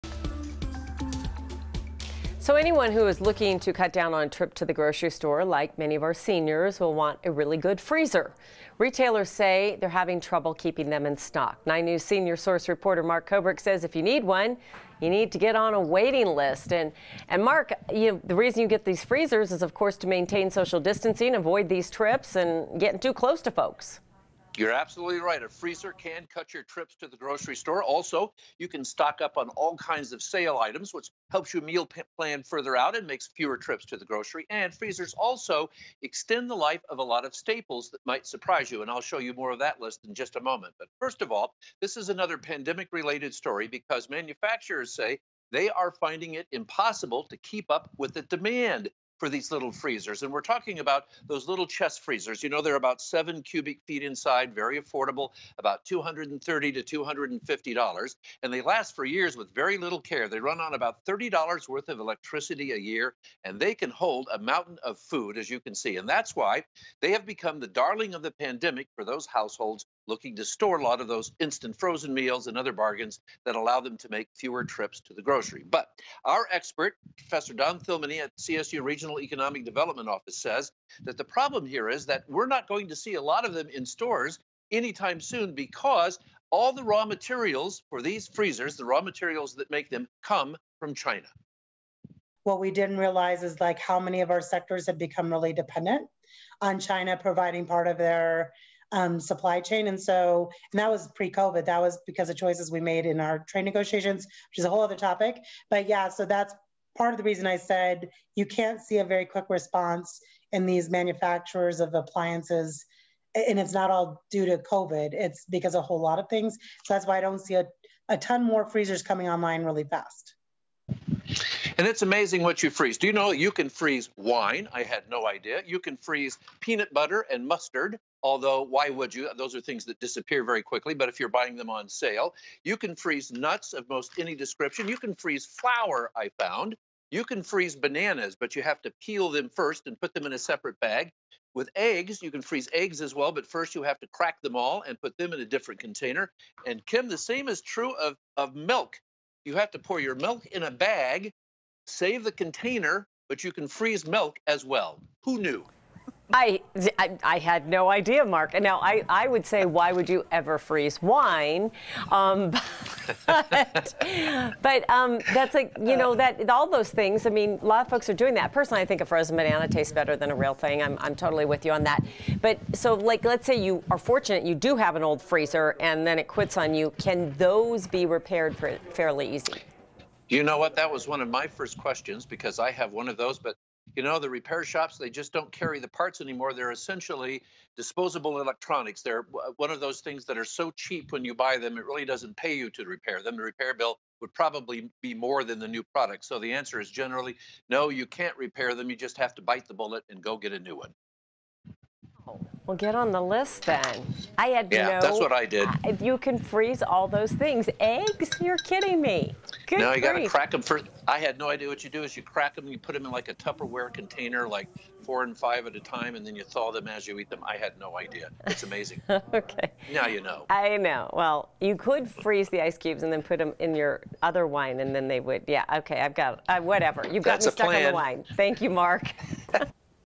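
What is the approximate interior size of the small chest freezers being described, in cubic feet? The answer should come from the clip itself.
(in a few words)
7 cubic feet.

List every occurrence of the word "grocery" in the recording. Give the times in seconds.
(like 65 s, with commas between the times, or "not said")
4 s, 27 s, 34 s, 75 s.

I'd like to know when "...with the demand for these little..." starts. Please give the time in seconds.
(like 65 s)
47 s.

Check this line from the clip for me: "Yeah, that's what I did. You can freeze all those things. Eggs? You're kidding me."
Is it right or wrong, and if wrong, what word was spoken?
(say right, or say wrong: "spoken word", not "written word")
right.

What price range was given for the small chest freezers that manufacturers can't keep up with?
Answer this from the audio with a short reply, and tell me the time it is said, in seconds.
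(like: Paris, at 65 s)
$230 to $250, at 55 s.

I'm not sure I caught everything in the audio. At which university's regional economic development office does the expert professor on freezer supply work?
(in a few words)
CSU.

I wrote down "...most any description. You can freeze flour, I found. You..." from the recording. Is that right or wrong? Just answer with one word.
right.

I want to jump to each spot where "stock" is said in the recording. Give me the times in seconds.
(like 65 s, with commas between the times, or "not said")
11 s, 28 s.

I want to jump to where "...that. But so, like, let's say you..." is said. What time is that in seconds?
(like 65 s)
171 s.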